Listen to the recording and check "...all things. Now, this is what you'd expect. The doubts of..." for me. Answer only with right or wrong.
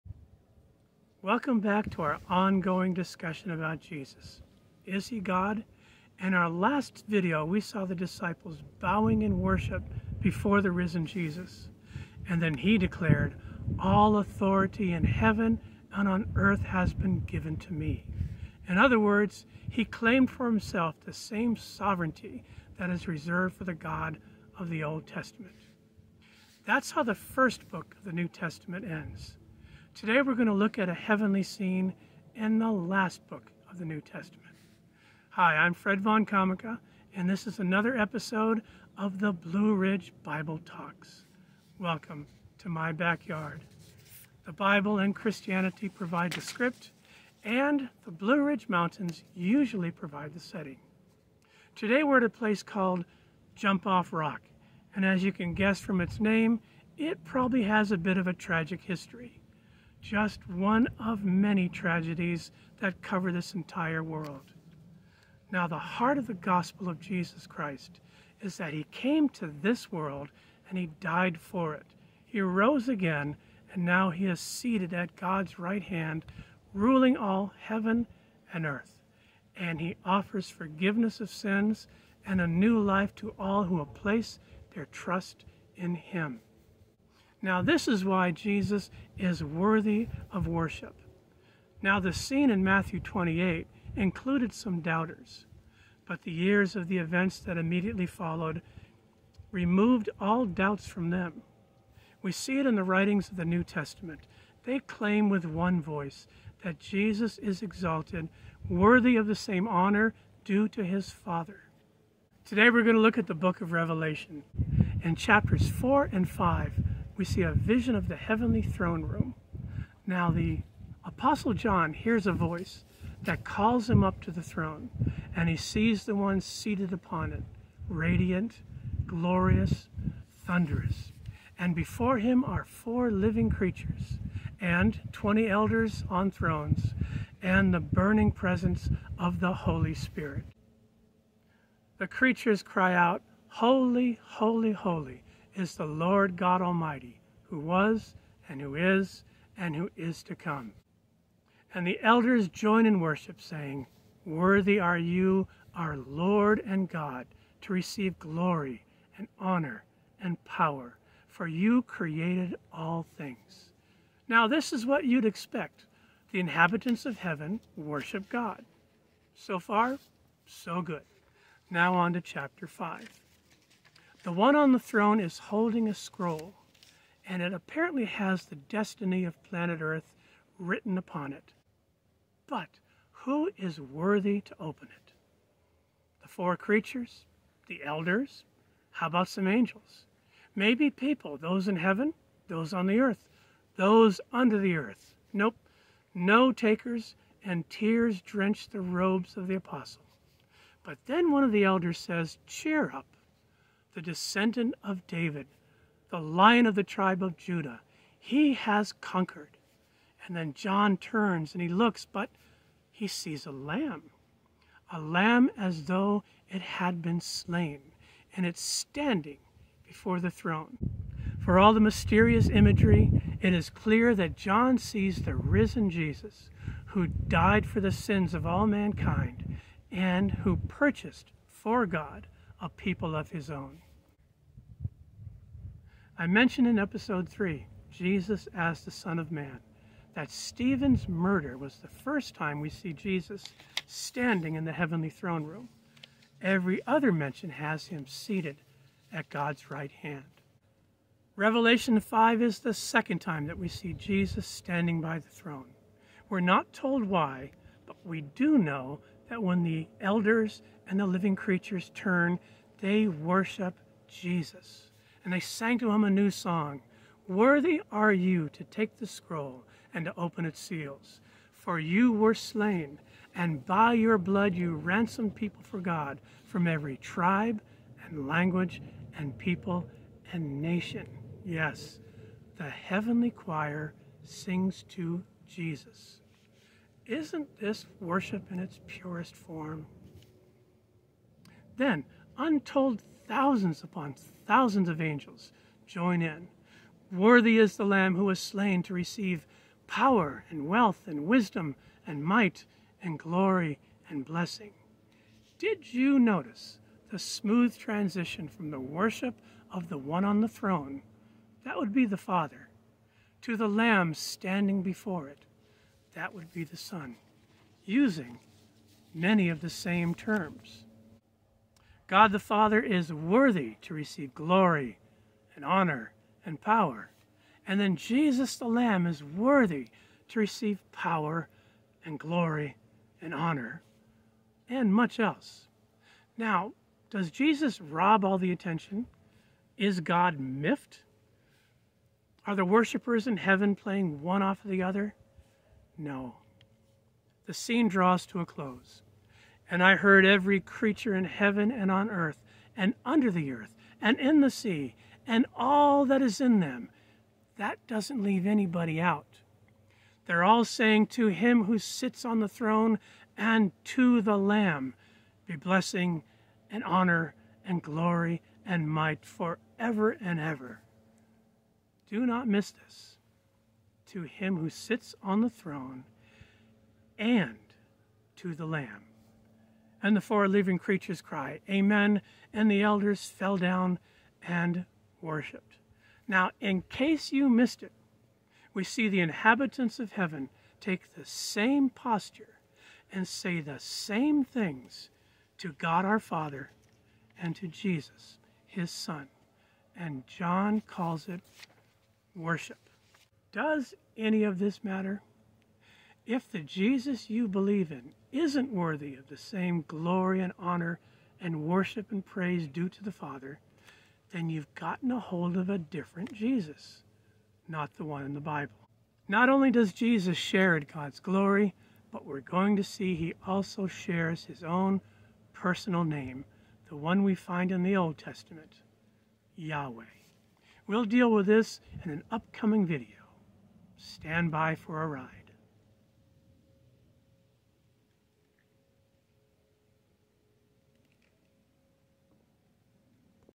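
wrong.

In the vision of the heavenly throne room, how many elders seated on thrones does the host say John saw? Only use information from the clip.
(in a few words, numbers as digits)
20.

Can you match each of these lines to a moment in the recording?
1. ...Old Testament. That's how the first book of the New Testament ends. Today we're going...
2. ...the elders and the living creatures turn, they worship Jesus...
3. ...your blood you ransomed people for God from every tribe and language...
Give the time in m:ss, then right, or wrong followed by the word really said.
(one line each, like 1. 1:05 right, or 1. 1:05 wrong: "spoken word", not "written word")
1. 0:24 right
2. 4:19 right
3. 4:33 right.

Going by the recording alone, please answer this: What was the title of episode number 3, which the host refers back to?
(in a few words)
Jesus as the Son of Man.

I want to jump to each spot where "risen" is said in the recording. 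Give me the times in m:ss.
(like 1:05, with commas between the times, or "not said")
0:10, 3:45.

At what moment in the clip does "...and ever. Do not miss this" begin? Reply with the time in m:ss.
6:10.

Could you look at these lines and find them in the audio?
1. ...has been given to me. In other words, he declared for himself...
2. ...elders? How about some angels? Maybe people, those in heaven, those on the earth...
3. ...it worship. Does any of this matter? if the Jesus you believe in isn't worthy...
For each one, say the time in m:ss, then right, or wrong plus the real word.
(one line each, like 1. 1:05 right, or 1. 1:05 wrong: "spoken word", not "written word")
1. 0:16 wrong: "claimed", not "declared"
2. 3:07 right
3. 6:41 right.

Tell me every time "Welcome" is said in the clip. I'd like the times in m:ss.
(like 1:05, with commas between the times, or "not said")
0:01, 0:41.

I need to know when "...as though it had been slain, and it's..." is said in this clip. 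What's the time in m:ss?
3:35.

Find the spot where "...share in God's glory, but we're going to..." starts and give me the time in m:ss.
7:00.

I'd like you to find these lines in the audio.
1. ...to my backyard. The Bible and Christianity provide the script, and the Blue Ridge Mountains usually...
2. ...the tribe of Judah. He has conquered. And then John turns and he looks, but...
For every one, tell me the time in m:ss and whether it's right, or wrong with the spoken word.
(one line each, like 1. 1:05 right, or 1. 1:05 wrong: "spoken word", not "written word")
1. 0:42 right
2. 3:26 right.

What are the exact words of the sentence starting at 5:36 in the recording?
Now, does Jesus rob all the attention?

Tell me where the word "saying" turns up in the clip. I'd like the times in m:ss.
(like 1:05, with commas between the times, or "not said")
2:33, 6:00.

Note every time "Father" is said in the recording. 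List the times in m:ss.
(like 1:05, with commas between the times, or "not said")
1:51, 5:12, 5:22, 6:36, 6:53.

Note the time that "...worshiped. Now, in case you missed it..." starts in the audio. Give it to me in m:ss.
6:25.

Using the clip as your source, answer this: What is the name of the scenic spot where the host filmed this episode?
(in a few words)
Jump Off Rock.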